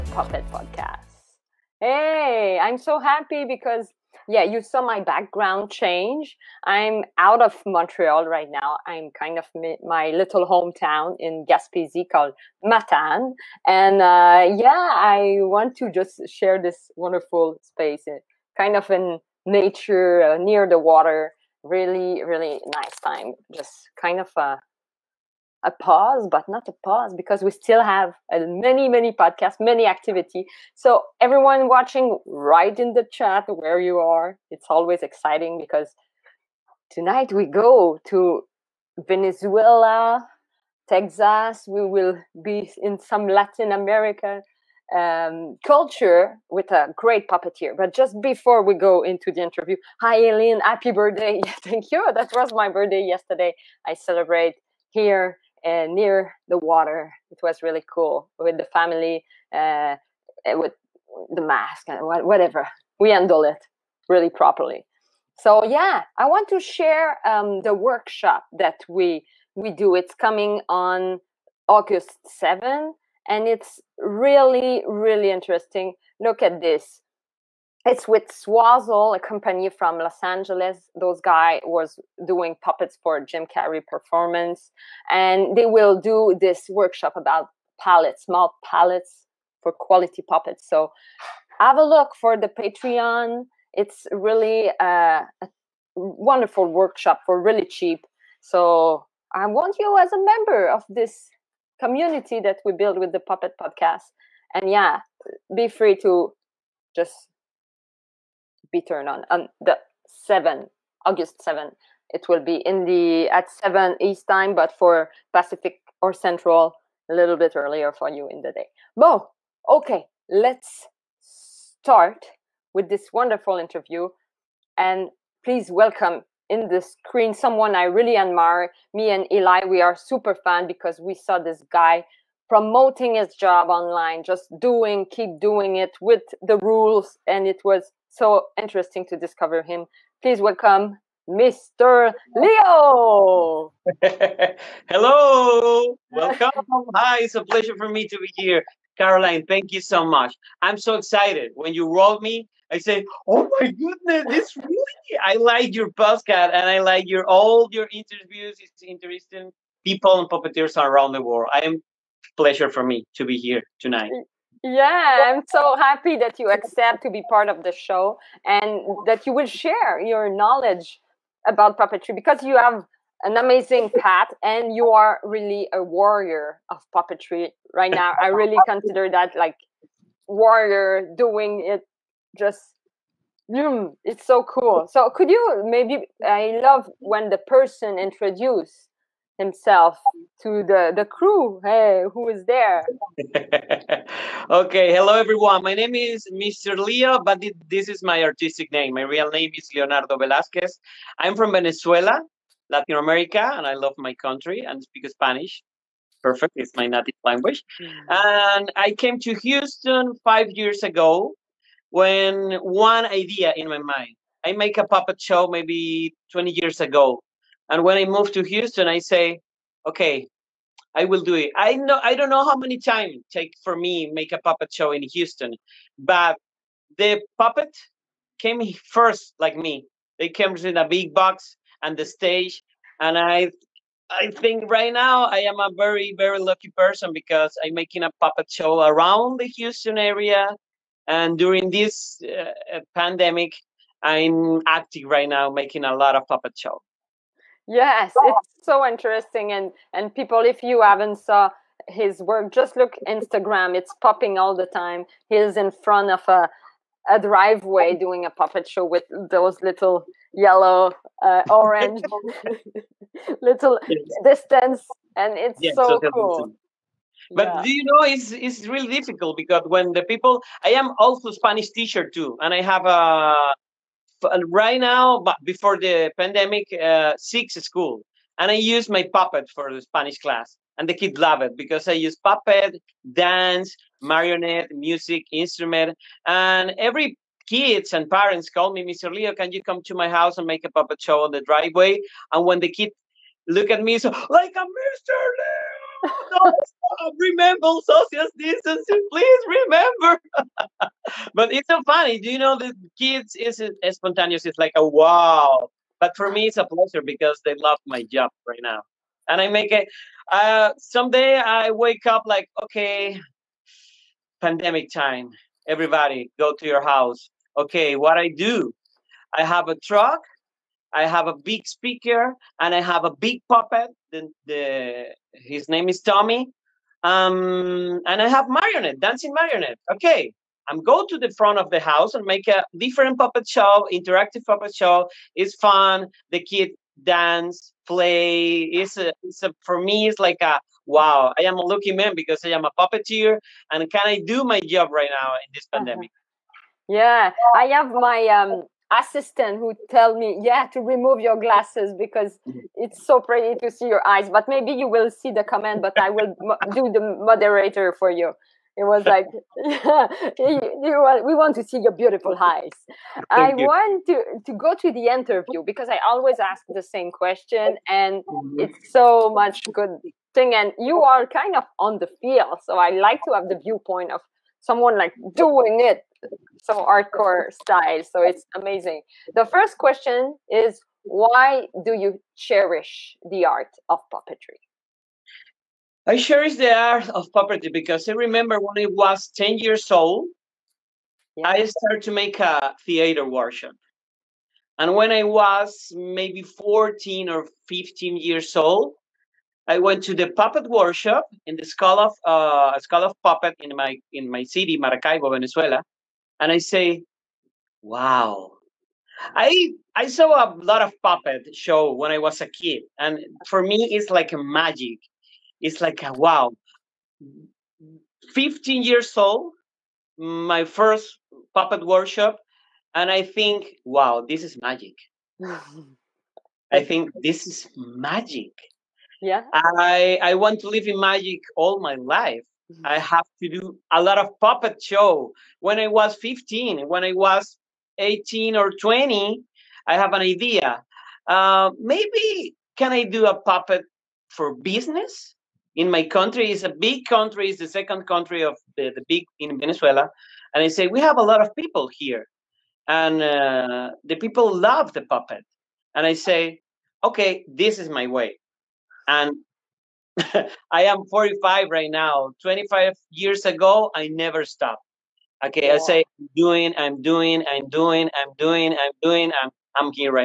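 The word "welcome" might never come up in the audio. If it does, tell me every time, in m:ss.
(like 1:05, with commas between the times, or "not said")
2:05, 2:20, 2:26.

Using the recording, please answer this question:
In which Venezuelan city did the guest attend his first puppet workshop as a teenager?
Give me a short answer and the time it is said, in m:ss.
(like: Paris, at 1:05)
Maracaibo, at 6:44.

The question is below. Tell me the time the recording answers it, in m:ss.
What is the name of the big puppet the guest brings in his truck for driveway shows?
5:26.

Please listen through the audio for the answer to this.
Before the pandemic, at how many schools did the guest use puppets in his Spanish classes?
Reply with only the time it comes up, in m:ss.
4:37.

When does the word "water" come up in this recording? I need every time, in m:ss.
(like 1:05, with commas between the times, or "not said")
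0:20, 0:56.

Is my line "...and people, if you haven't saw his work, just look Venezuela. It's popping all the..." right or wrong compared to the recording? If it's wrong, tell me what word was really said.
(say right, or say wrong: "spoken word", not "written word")
wrong: "Instagram", not "Venezuela".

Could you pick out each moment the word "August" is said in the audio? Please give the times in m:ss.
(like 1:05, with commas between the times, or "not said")
1:11, 1:51.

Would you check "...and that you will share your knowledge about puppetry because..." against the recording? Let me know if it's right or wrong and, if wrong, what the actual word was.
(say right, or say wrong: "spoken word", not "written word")
right.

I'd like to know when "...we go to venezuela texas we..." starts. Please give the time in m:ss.
0:37.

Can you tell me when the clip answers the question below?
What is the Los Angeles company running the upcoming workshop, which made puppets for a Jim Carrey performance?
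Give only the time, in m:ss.
1:18.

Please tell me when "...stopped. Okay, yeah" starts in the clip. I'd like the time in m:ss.
7:44.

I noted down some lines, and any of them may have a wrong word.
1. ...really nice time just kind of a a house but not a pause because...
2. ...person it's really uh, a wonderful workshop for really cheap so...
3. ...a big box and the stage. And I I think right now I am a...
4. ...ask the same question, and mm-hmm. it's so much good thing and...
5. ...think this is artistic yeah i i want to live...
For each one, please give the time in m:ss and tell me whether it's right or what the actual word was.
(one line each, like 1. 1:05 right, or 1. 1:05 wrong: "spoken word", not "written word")
1. 0:22 wrong: "pause", not "house"
2. 1:32 wrong: "patreon", not "person"
3. 3:50 right
4. 6:06 right
5. 7:06 wrong: "magic", not "artistic".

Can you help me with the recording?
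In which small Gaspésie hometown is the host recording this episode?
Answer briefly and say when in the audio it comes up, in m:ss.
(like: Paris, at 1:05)
Matane, at 0:12.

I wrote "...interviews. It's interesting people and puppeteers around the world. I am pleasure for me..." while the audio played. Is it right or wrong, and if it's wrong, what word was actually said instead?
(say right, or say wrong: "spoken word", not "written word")
right.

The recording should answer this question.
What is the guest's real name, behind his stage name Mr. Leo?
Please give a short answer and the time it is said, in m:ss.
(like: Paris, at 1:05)
Leonardo Velasquez, at 3:19.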